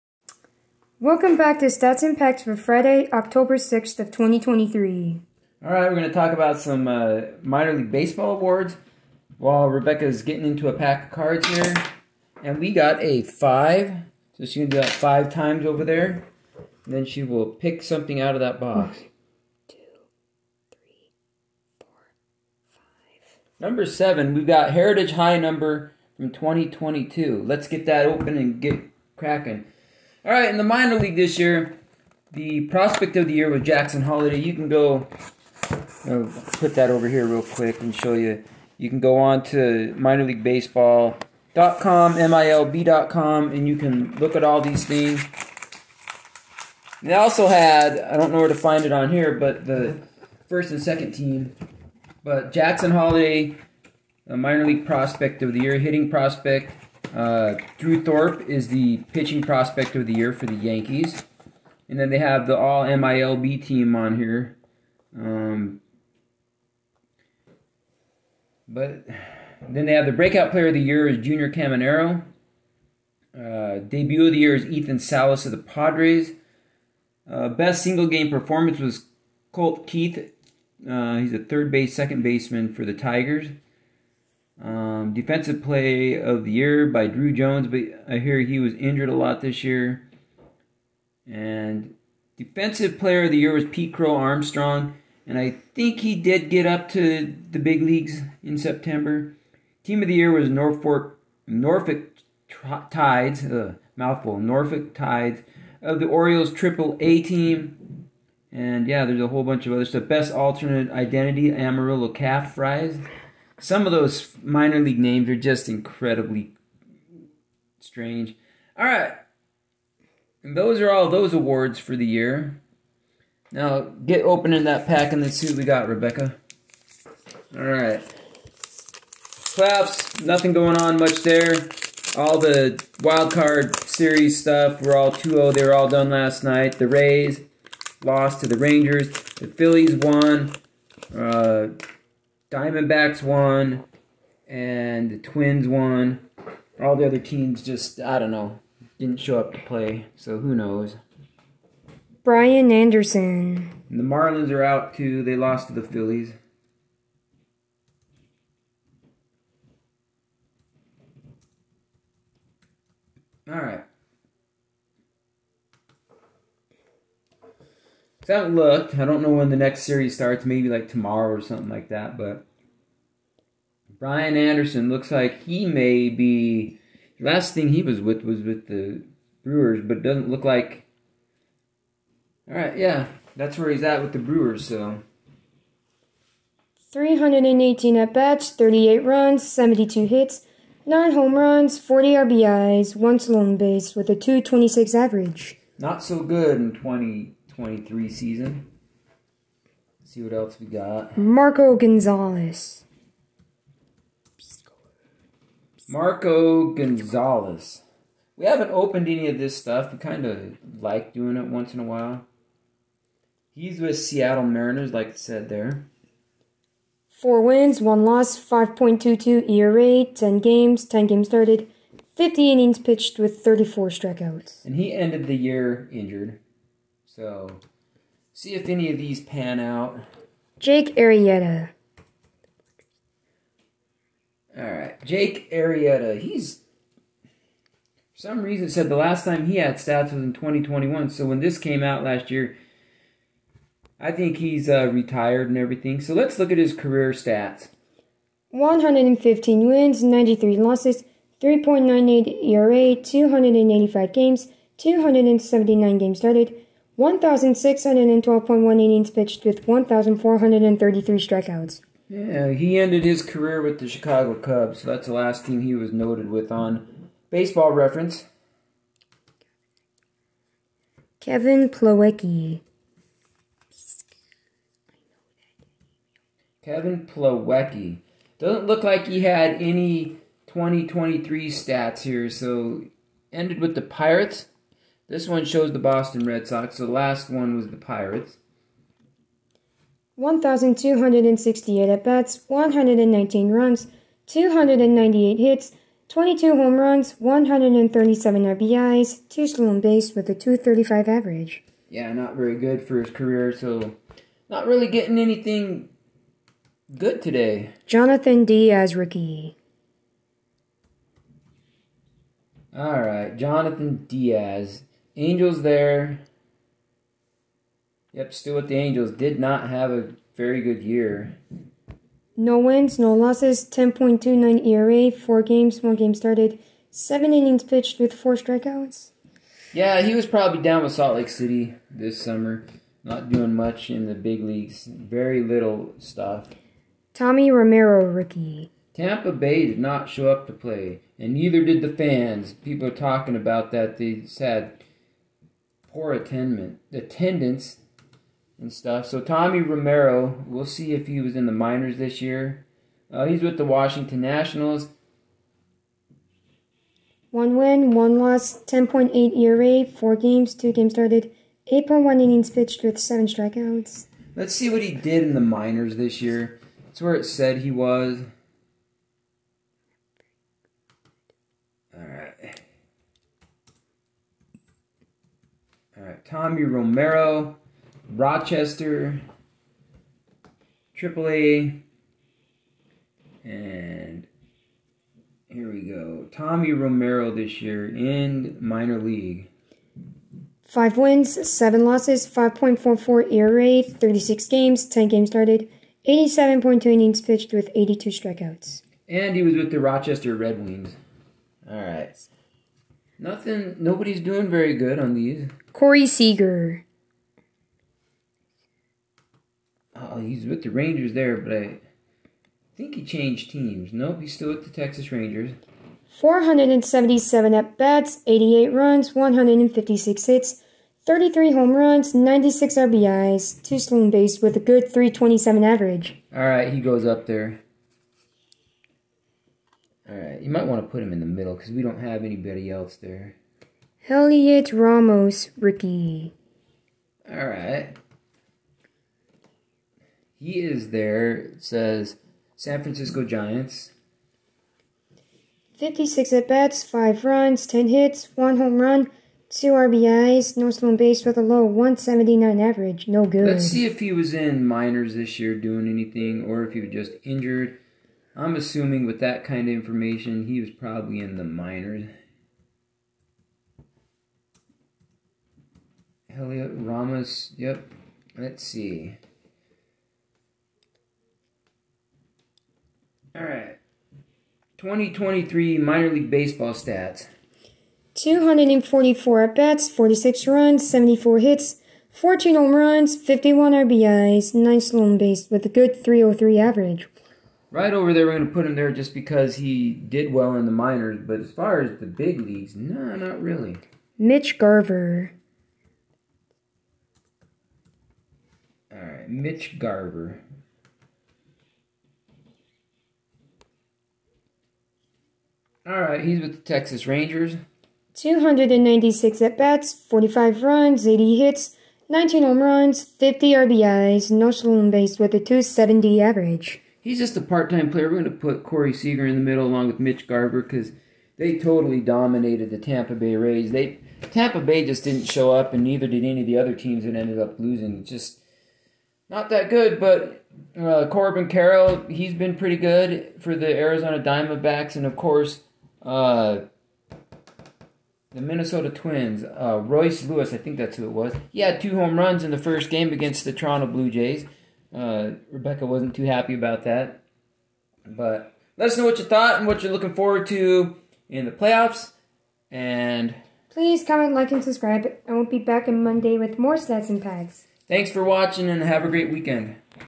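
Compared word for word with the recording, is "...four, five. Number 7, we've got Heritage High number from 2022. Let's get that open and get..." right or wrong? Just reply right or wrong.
right.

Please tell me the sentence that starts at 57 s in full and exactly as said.
Uh, Drew Thorpe is the pitching prospect of the year for the Yankees.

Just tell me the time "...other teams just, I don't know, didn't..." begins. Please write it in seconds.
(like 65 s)
147 s.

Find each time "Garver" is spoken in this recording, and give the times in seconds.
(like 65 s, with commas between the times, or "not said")
494 s, 499 s, 520 s.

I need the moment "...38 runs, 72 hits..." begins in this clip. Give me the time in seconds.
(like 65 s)
188 s.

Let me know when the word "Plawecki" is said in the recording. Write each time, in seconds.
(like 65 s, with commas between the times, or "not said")
271 s, 277 s.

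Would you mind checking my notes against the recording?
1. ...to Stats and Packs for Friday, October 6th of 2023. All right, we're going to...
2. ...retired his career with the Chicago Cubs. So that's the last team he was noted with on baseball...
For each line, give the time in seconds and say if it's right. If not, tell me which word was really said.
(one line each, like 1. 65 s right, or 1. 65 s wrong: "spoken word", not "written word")
1. 1 s right
2. 262 s wrong: "ended", not "retired".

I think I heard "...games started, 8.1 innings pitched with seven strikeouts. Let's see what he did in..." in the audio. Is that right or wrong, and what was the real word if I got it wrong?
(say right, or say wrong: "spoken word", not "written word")
right.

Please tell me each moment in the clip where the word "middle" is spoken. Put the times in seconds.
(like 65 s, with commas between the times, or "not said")
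431 s, 519 s.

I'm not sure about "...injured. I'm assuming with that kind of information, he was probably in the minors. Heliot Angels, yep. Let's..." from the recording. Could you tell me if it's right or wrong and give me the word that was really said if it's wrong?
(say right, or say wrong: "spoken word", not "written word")
wrong: "Ramos", not "Angels".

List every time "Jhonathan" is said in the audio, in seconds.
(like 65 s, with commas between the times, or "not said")
307 s, 313 s.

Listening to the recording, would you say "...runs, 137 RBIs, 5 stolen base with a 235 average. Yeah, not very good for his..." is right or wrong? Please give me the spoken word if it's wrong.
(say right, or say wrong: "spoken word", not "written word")
wrong: "2", not "5".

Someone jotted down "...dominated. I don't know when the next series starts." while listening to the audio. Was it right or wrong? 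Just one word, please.
wrong.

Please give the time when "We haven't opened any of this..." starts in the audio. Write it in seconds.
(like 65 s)
208 s.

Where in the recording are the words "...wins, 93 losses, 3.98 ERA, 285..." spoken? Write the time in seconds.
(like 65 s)
249 s.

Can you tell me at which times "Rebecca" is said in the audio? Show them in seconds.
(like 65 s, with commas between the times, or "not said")
9 s, 125 s, 545 s.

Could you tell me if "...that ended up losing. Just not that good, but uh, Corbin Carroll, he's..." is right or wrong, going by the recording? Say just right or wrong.
right.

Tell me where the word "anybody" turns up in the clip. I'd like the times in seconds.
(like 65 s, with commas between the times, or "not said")
432 s.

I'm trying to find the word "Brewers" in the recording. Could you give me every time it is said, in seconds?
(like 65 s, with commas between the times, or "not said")
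179 s, 184 s.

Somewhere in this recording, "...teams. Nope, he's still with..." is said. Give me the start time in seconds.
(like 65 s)
413 s.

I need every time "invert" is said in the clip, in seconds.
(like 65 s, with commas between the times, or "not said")
not said.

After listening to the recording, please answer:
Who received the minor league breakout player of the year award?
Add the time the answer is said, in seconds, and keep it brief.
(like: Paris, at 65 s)
Junior Caminero, at 71 s.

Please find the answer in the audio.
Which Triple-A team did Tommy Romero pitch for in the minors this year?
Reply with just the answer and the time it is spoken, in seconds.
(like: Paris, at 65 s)
Rochester Red Wings, at 399 s.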